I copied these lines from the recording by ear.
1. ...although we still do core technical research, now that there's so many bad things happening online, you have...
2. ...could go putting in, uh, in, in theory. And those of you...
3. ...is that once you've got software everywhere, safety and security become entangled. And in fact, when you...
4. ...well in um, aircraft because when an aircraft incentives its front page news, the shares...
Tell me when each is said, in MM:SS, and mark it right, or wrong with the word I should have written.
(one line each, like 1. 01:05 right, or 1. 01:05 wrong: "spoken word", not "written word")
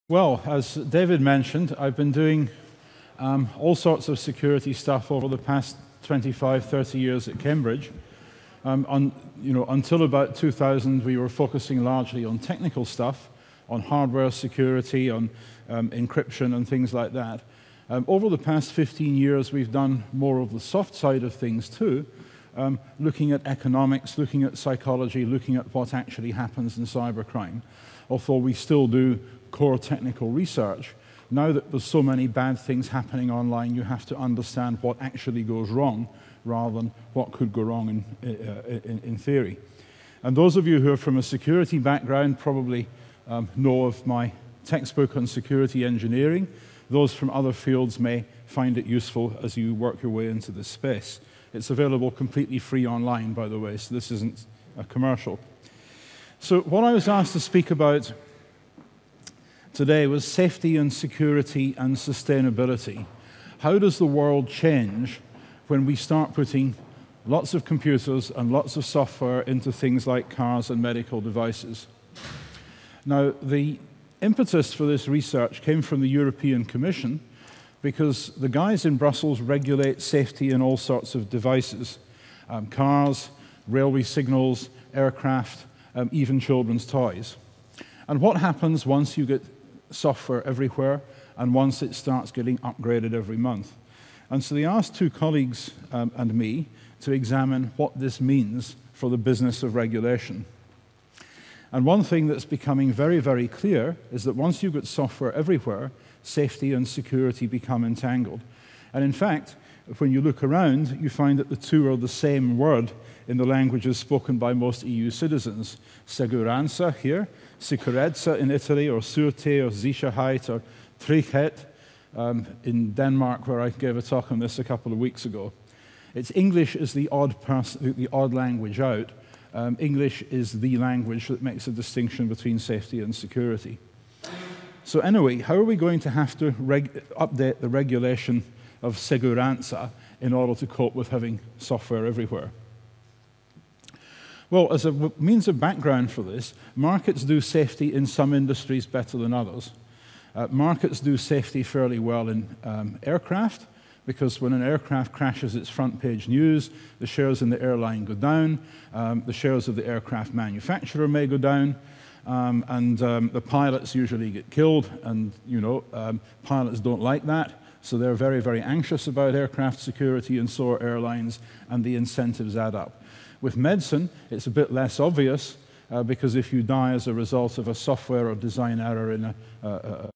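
1. 00:28 right
2. 00:37 wrong: "wrong", not "putting"
3. 01:44 right
4. 02:31 wrong: "crashes", not "incentives".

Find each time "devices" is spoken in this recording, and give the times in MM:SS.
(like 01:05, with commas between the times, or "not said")
01:11, 01:21.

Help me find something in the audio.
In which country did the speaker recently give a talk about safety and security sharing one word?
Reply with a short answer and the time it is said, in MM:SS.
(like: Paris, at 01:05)
Denmark, at 02:02.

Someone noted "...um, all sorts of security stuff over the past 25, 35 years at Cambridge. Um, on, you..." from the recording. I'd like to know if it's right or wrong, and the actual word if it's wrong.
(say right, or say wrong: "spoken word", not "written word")
wrong: "30", not "35".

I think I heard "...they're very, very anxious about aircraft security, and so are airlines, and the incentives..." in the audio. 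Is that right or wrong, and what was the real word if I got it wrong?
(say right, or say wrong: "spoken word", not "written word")
right.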